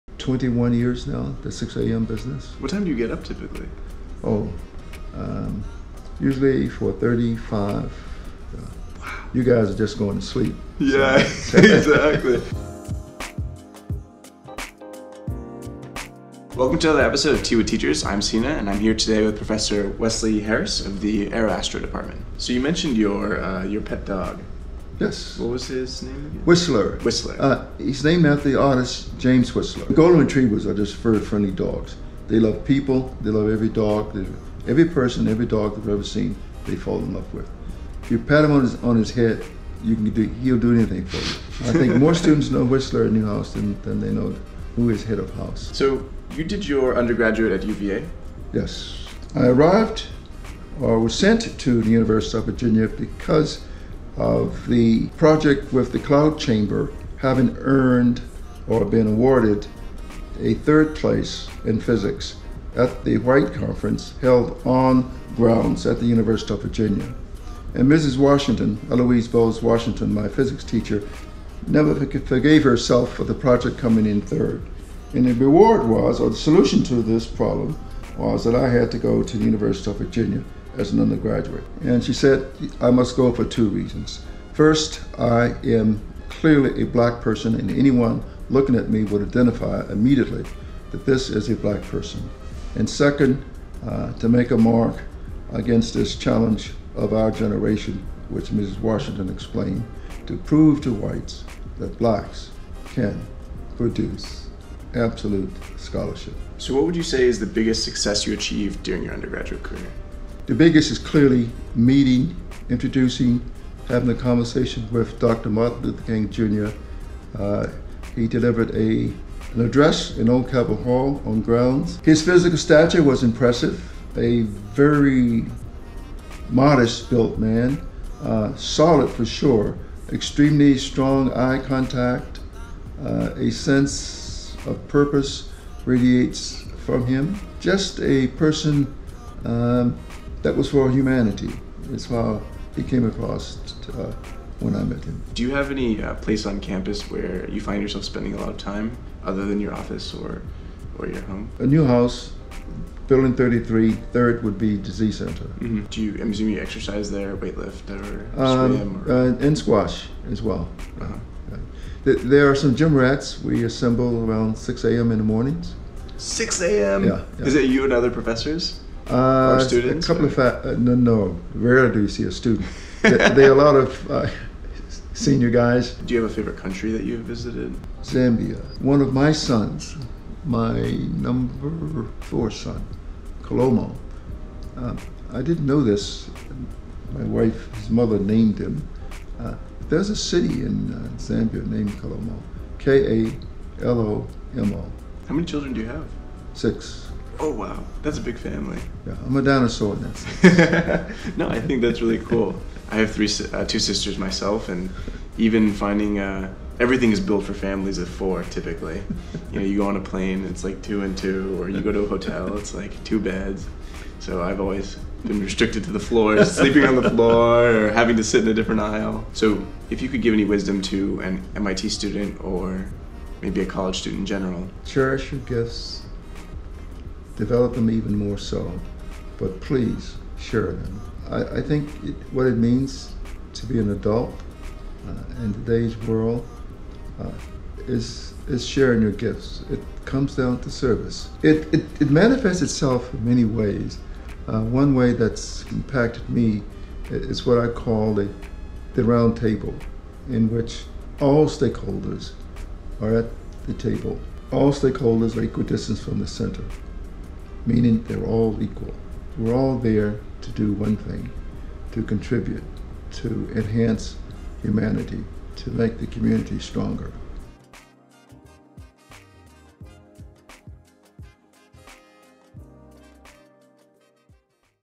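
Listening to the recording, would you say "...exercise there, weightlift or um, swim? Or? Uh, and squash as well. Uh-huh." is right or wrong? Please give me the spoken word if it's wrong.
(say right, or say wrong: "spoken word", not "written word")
right.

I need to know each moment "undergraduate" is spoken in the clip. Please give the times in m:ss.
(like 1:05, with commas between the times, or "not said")
0:46, 1:21, 1:49.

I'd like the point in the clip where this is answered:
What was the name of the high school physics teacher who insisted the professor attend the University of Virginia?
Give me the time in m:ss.
1:08.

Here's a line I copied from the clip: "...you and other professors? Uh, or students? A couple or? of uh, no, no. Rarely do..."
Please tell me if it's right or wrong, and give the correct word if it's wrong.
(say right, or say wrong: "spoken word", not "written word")
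right.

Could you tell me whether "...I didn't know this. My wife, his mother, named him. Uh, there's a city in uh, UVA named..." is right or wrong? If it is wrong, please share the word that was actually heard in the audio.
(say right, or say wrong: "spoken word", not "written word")
wrong: "Zambia", not "UVA".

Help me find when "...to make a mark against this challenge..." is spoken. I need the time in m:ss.
1:34.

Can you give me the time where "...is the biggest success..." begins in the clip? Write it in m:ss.
1:47.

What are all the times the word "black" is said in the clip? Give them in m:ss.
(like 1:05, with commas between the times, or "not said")
1:26, 1:31, 1:41.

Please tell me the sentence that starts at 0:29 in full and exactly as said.
Golden Retrievers are just very friendly dogs.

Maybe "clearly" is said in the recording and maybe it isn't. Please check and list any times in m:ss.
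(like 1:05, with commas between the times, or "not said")
1:26, 1:50.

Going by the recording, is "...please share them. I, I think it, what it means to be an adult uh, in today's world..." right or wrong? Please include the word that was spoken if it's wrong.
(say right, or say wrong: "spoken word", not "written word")
right.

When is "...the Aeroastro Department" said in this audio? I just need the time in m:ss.
0:21.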